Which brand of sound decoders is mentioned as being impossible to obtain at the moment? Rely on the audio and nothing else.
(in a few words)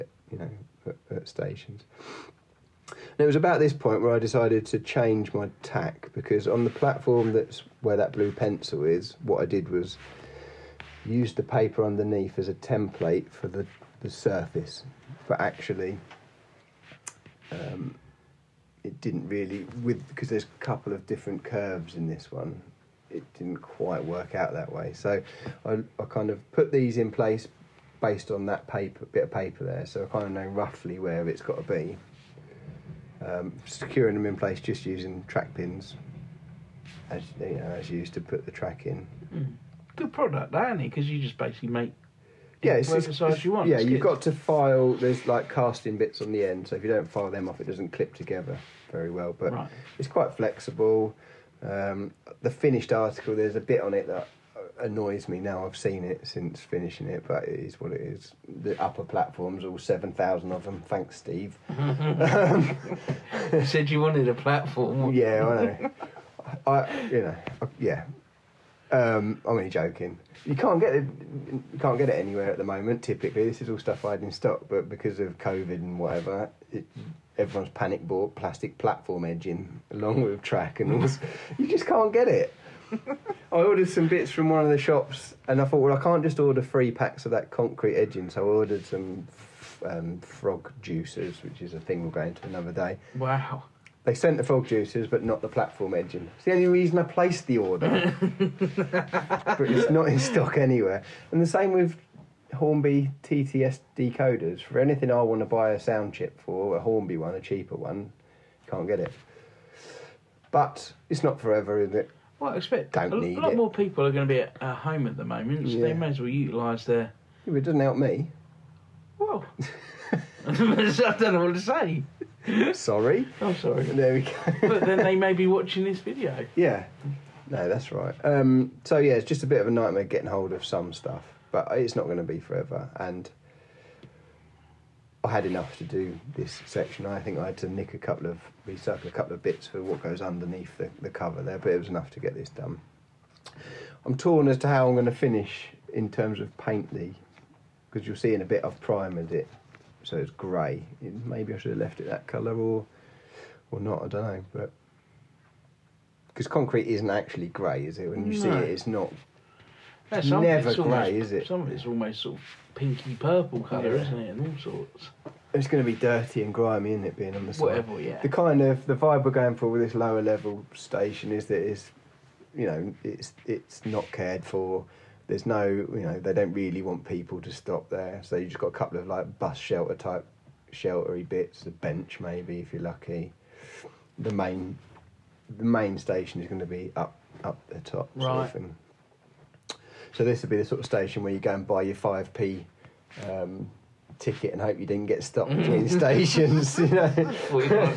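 Hornby TTS.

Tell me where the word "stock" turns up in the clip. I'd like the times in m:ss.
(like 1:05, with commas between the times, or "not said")
1:14, 1:40.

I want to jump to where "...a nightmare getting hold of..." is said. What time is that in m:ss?
2:09.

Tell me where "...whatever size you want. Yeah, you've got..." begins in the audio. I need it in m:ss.
0:42.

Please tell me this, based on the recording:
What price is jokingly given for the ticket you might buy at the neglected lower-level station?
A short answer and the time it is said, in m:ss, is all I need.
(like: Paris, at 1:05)
5p, at 3:11.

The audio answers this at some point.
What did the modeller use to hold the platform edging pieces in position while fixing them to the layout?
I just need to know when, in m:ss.
0:35.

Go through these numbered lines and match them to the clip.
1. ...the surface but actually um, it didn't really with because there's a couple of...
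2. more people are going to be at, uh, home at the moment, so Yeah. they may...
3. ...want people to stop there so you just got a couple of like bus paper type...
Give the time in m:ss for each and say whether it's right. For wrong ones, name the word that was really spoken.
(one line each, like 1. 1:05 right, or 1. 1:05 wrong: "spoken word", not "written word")
1. 0:14 right
2. 1:53 right
3. 2:56 wrong: "shelter", not "paper".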